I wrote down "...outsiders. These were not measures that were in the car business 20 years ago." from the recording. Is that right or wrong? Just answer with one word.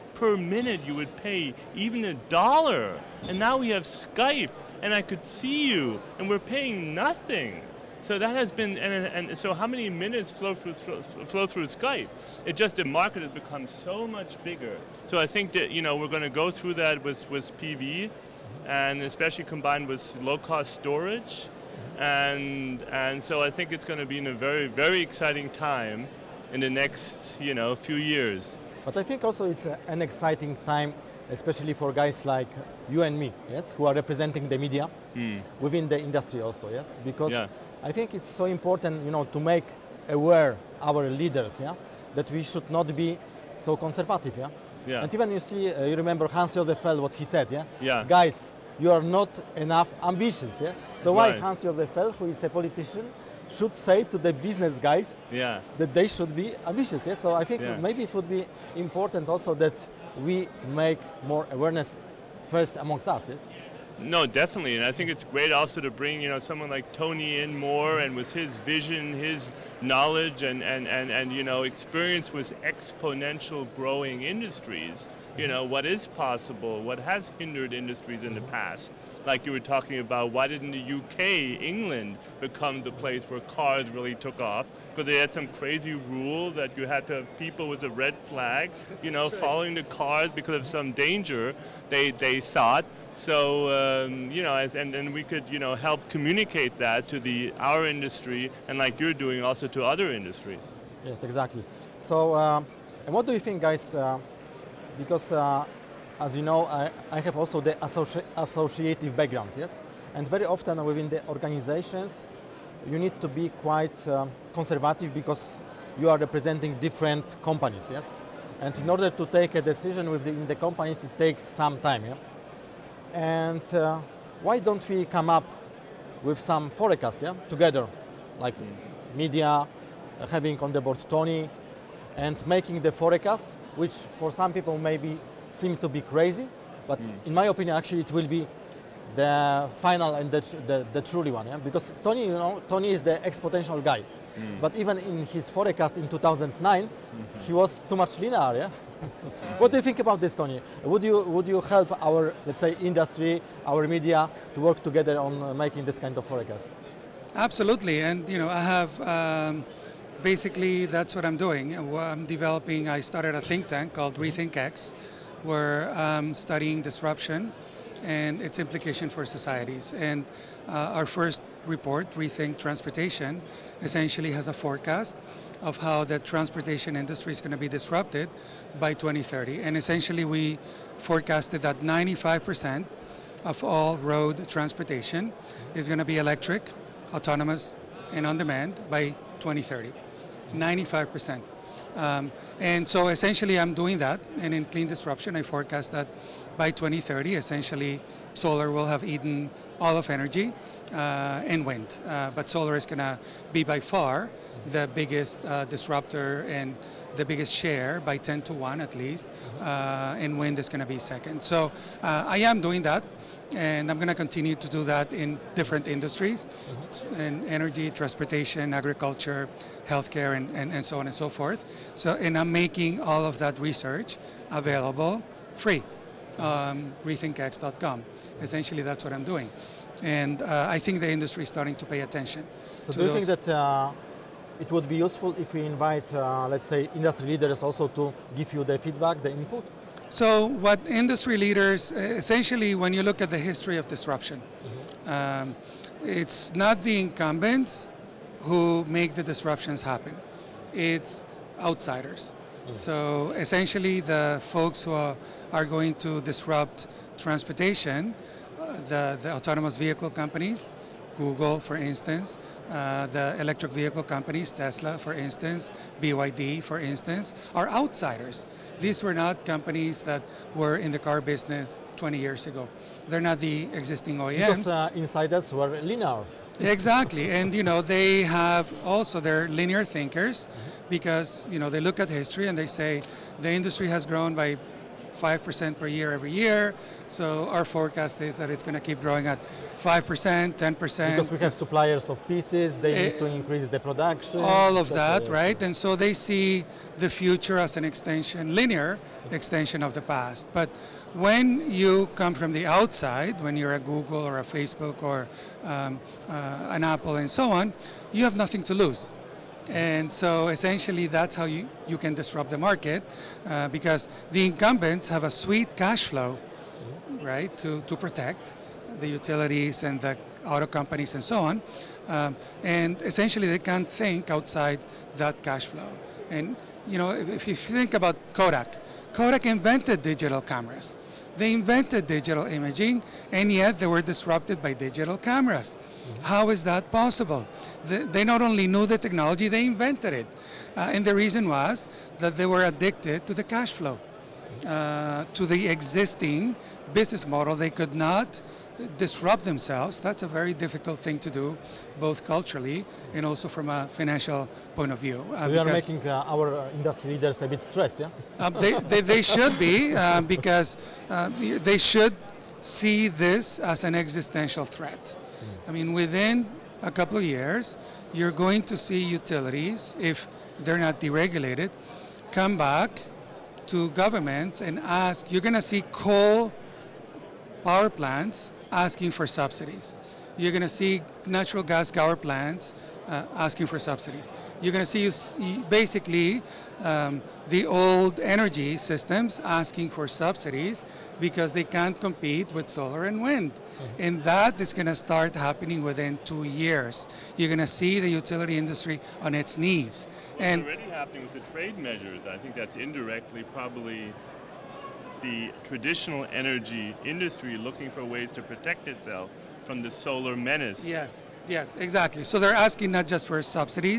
wrong.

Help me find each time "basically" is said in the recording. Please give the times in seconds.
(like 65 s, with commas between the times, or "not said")
160 s, 385 s.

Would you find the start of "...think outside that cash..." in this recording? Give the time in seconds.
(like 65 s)
323 s.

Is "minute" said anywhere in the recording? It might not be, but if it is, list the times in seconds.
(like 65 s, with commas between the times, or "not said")
0 s, 9 s.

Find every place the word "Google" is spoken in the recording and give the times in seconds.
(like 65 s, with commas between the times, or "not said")
261 s, 303 s.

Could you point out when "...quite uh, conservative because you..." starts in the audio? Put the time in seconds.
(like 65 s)
113 s.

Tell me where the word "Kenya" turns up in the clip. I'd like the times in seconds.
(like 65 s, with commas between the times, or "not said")
not said.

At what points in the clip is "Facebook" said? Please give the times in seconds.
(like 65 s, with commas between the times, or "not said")
304 s.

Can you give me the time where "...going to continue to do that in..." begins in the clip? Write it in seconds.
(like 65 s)
213 s.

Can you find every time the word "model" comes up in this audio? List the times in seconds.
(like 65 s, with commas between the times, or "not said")
347 s.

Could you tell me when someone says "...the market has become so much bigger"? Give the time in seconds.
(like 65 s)
12 s.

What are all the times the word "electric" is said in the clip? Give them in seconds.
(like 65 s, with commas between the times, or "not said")
186 s, 263 s.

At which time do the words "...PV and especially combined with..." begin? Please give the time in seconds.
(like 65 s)
17 s.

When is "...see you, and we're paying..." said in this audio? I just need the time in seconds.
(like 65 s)
5 s.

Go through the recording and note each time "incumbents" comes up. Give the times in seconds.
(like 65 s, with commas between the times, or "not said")
246 s, 314 s.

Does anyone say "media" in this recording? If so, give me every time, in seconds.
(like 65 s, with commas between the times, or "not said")
34 s, 129 s, 153 s.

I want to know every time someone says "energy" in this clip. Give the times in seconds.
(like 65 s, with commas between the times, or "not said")
200 s, 217 s, 388 s, 406 s.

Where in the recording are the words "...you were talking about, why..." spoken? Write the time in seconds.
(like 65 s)
79 s.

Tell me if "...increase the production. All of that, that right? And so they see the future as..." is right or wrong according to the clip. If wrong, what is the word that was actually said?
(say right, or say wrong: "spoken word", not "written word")
right.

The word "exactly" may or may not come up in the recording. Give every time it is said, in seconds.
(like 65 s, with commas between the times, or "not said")
101 s, 276 s, 411 s.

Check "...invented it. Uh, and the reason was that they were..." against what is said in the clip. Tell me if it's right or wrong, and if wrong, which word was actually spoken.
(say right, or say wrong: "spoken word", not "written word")
right.